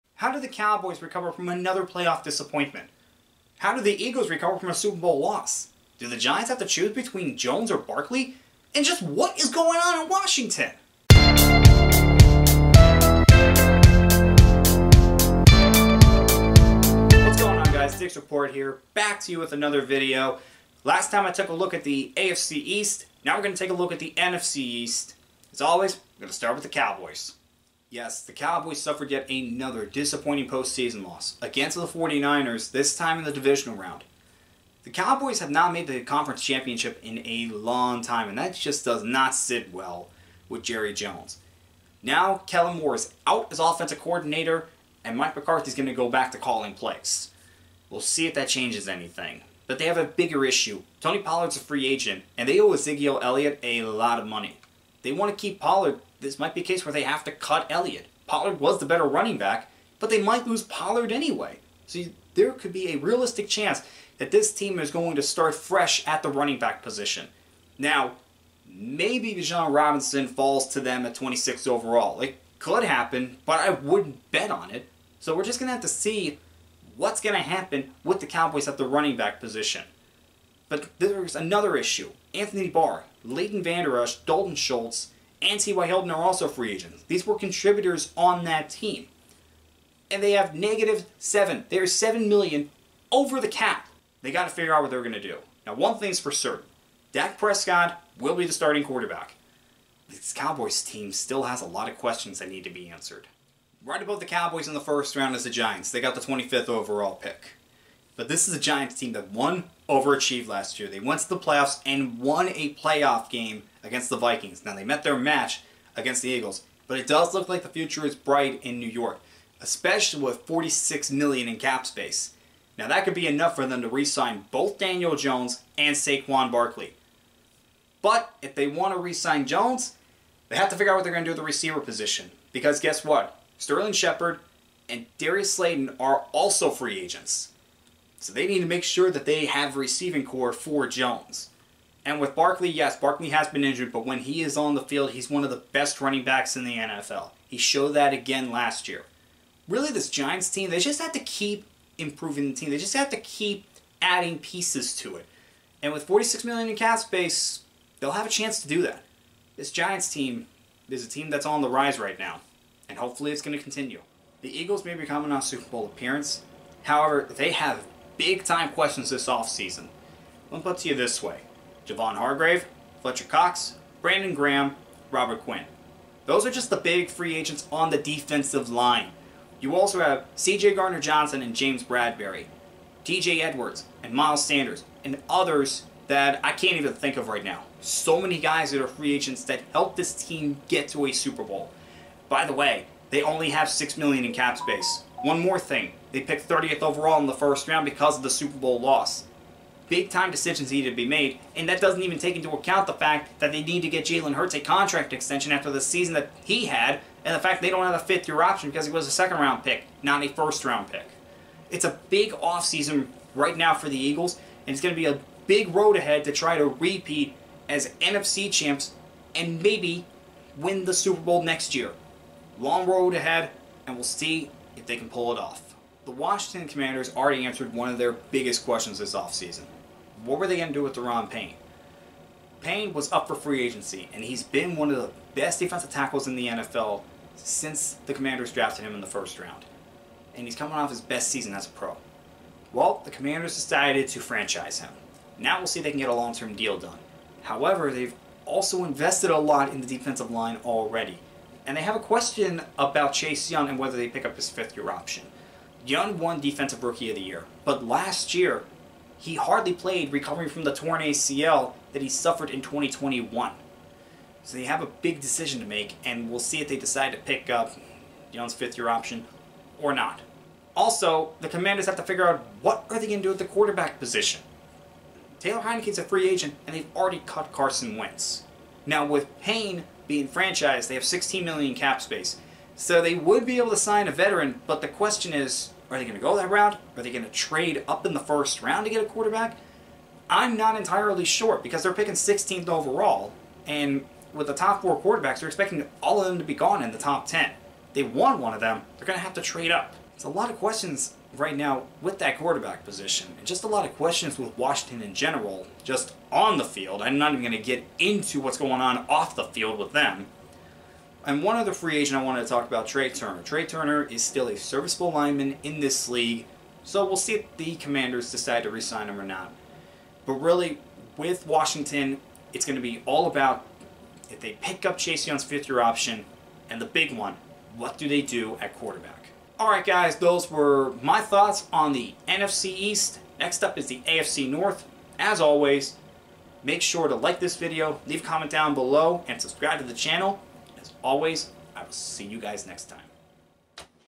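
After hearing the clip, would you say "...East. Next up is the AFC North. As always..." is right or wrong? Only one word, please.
right.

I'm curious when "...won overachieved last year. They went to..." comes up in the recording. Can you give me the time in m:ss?
1:49.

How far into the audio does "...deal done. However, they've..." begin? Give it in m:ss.
4:06.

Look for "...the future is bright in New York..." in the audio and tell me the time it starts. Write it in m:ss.
1:57.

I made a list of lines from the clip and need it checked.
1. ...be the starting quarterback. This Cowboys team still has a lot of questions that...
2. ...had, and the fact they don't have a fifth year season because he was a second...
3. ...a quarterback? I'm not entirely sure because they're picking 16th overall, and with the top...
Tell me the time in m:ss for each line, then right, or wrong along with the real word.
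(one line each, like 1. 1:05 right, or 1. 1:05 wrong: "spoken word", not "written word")
1. 1:38 right
2. 3:26 wrong: "option", not "season"
3. 4:49 right.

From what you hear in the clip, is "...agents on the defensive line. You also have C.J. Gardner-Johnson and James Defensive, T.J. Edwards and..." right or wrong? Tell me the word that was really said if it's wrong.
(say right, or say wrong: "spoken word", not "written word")
wrong: "Bradberry", not "Defensive".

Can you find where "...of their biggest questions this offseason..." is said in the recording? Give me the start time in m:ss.
3:47.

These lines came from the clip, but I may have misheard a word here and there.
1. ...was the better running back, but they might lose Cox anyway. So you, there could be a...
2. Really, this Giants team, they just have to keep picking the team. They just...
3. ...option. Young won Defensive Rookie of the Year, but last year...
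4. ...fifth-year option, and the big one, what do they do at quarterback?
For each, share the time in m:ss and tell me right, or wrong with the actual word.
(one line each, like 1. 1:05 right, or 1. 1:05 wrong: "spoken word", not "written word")
1. 0:58 wrong: "Pollard", not "Cox"
2. 2:29 wrong: "improving", not "picking"
3. 4:14 right
4. 5:25 right.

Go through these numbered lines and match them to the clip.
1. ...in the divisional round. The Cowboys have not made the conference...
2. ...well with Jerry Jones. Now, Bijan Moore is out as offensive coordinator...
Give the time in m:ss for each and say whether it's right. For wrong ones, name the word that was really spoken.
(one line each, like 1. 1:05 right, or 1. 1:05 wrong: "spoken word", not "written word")
1. 0:33 right
2. 0:39 wrong: "Kellen", not "Bijan".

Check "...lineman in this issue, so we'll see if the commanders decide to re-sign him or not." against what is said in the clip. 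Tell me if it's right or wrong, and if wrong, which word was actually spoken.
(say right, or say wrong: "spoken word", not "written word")
wrong: "league", not "issue".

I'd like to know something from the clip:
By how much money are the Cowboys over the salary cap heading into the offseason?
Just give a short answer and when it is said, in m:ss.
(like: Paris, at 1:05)
7 million, at 1:31.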